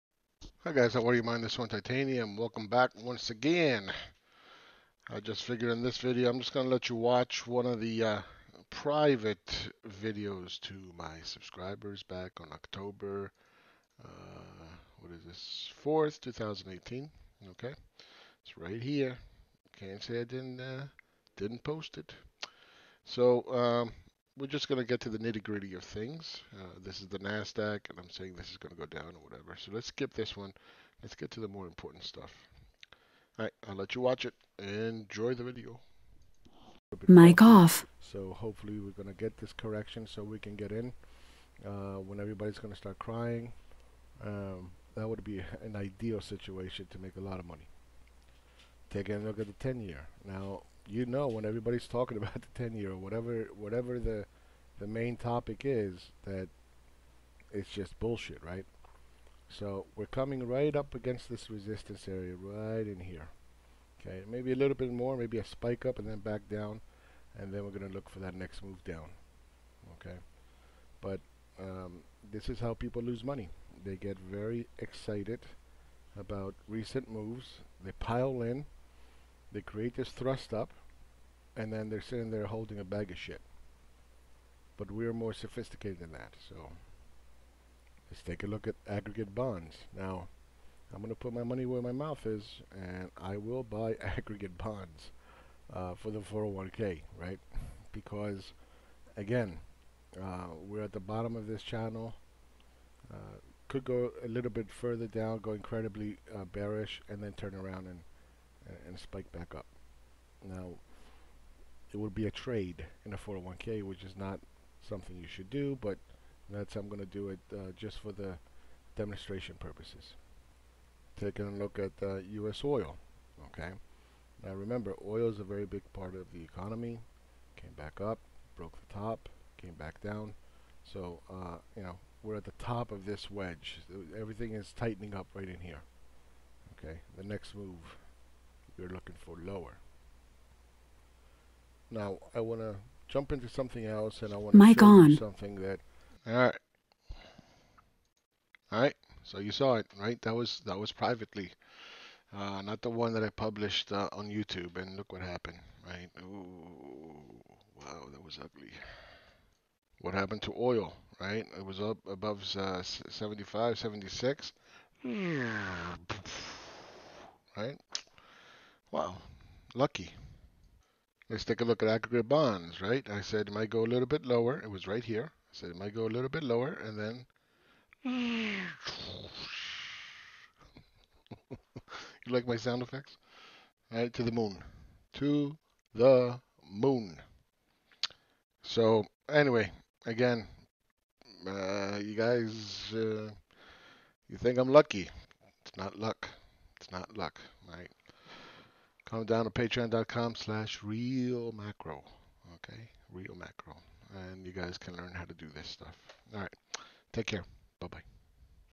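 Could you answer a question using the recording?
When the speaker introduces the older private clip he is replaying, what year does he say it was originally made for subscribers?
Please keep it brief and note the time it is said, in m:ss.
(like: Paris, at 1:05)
2018, at 0:16.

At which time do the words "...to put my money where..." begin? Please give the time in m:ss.
1:31.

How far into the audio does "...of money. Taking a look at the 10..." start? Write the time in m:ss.
0:47.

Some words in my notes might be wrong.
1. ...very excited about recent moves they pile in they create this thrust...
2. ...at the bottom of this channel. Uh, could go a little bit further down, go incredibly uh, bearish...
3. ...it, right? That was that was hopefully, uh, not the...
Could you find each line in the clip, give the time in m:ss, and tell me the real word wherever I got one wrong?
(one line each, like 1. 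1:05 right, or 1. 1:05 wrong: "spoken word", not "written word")
1. 1:14 right
2. 1:40 right
3. 2:29 wrong: "privately", not "hopefully".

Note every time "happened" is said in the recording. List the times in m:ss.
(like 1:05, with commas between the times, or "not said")
2:35, 2:40.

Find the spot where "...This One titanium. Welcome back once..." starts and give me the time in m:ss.
0:01.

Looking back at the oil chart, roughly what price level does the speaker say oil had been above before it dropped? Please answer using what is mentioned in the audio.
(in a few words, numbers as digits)
75.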